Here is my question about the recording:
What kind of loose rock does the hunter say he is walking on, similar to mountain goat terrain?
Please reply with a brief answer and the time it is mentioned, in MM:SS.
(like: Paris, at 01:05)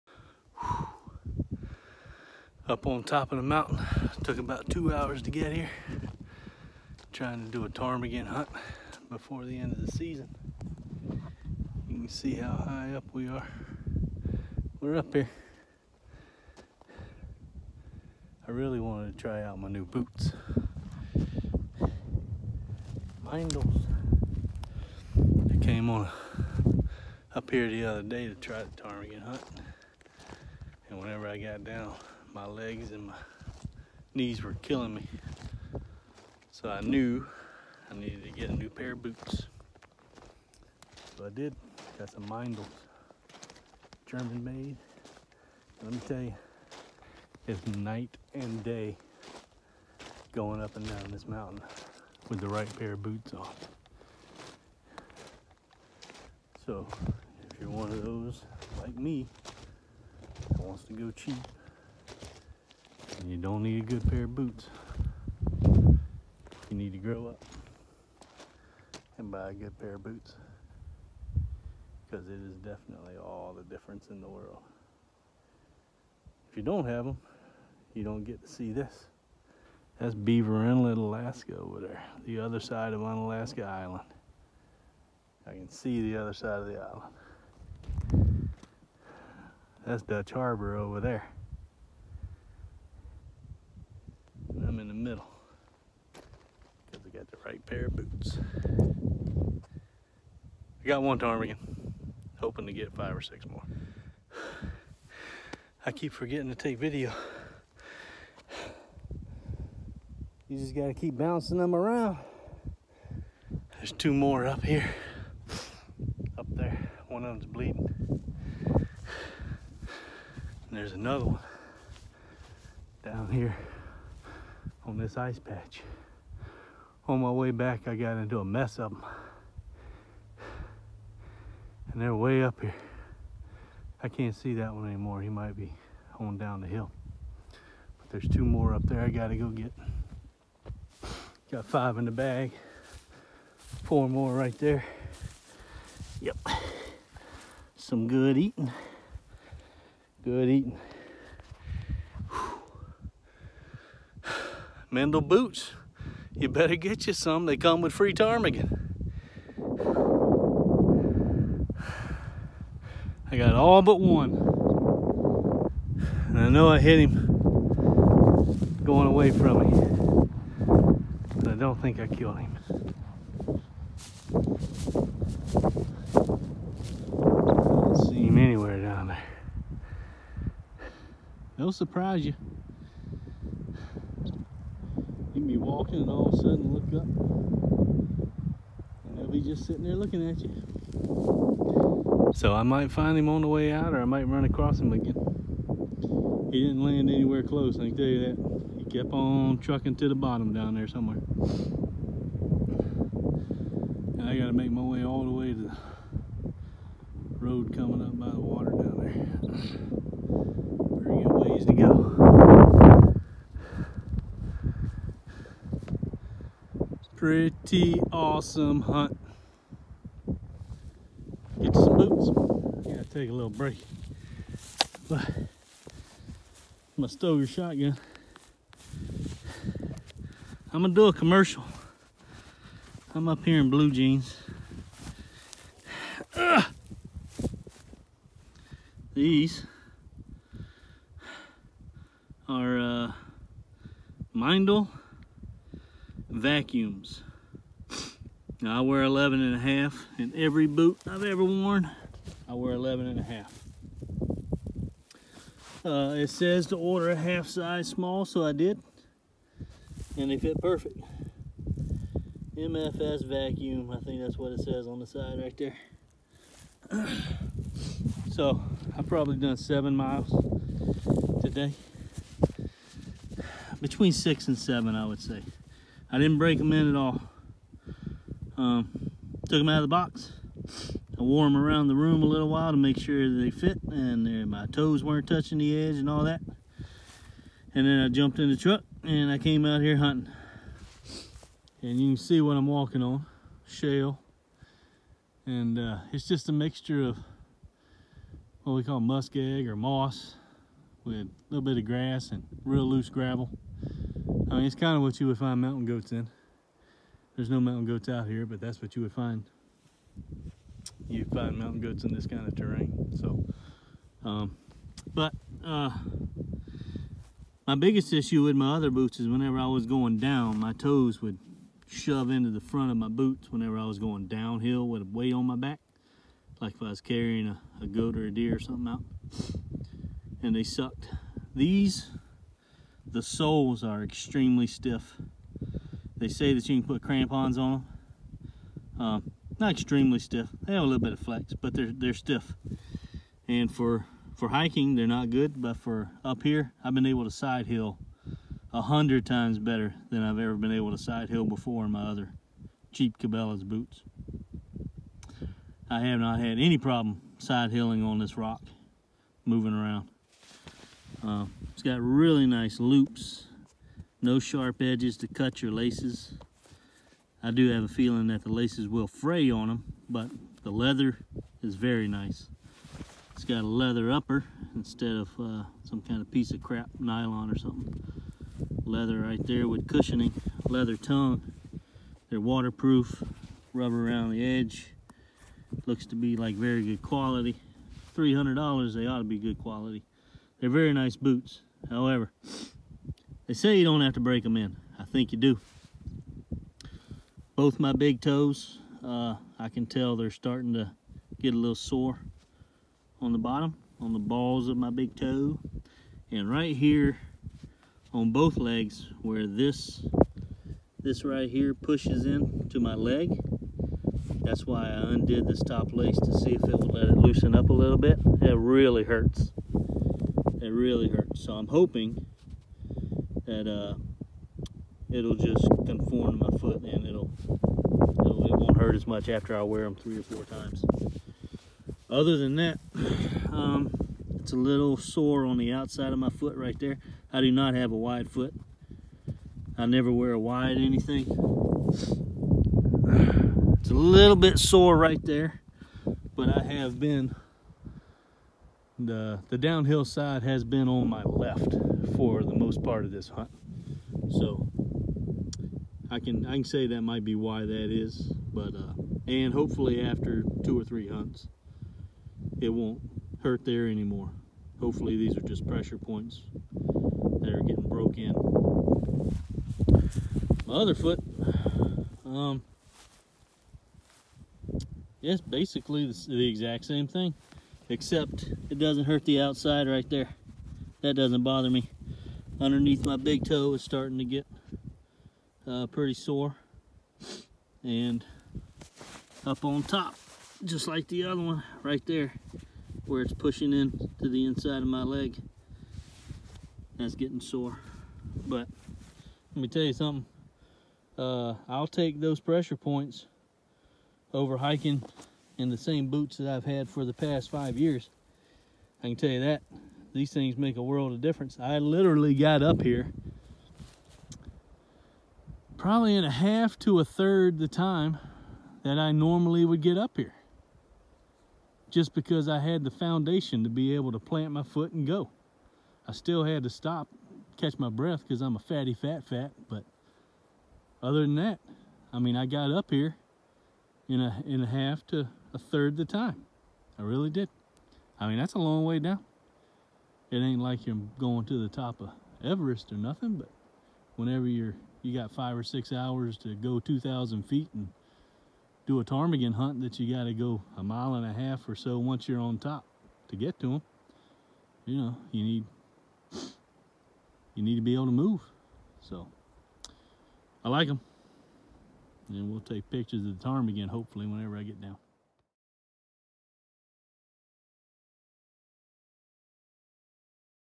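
shale, at 04:53.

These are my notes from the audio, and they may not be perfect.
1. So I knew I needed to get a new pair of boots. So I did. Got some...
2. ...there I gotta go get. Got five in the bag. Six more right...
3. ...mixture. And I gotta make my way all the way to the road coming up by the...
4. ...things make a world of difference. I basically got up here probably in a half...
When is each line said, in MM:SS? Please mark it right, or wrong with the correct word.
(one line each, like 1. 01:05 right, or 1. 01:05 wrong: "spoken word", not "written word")
1. 00:36 right
2. 02:18 wrong: "Four", not "Six"
3. 03:20 wrong: "somewhere", not "mixture"
4. 08:30 wrong: "literally", not "basically".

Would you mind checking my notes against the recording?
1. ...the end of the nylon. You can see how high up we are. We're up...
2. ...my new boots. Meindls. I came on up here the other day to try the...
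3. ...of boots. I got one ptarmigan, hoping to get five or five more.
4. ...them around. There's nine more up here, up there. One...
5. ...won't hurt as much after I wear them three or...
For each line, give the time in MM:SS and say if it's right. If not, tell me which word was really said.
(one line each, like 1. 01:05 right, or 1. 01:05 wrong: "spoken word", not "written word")
1. 00:09 wrong: "season", not "nylon"
2. 00:19 right
3. 01:37 wrong: "six", not "five"
4. 01:51 wrong: "two", not "nine"
5. 07:08 right.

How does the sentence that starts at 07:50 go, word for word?
My other foot, um, yes, basically the, the exact same thing except it doesn't hurt the outside right there.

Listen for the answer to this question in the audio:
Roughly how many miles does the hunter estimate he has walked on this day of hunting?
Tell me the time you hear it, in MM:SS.
04:29.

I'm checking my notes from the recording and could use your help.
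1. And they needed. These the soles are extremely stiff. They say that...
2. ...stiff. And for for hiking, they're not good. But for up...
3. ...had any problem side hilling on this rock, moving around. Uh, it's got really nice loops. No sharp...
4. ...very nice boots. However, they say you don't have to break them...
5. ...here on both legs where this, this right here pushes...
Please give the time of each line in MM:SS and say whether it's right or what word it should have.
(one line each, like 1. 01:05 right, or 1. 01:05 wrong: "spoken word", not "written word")
1. 05:30 wrong: "sucked", not "needed"
2. 05:42 right
3. 05:56 right
4. 06:30 right
5. 06:46 right.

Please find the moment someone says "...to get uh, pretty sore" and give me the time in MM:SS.
08:04.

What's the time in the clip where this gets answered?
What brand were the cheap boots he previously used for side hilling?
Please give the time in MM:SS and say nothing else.
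05:53.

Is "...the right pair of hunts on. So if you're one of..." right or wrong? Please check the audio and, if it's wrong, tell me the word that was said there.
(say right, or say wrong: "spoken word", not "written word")
wrong: "boots", not "hunts".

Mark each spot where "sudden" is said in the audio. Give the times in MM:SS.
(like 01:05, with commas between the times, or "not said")
03:06.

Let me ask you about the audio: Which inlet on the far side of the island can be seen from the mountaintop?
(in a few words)
Beaver Inlet.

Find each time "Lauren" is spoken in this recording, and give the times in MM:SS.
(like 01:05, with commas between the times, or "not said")
not said.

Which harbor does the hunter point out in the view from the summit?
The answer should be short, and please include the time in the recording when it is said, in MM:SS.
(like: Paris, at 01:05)
Dutch Harbor, at 01:30.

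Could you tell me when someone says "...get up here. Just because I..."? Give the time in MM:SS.
08:39.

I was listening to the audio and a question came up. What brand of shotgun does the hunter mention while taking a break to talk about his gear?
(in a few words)
Stoeger.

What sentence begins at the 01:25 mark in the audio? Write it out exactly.
I can see the other side of the island.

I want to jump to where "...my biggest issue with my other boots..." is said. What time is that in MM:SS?
05:17.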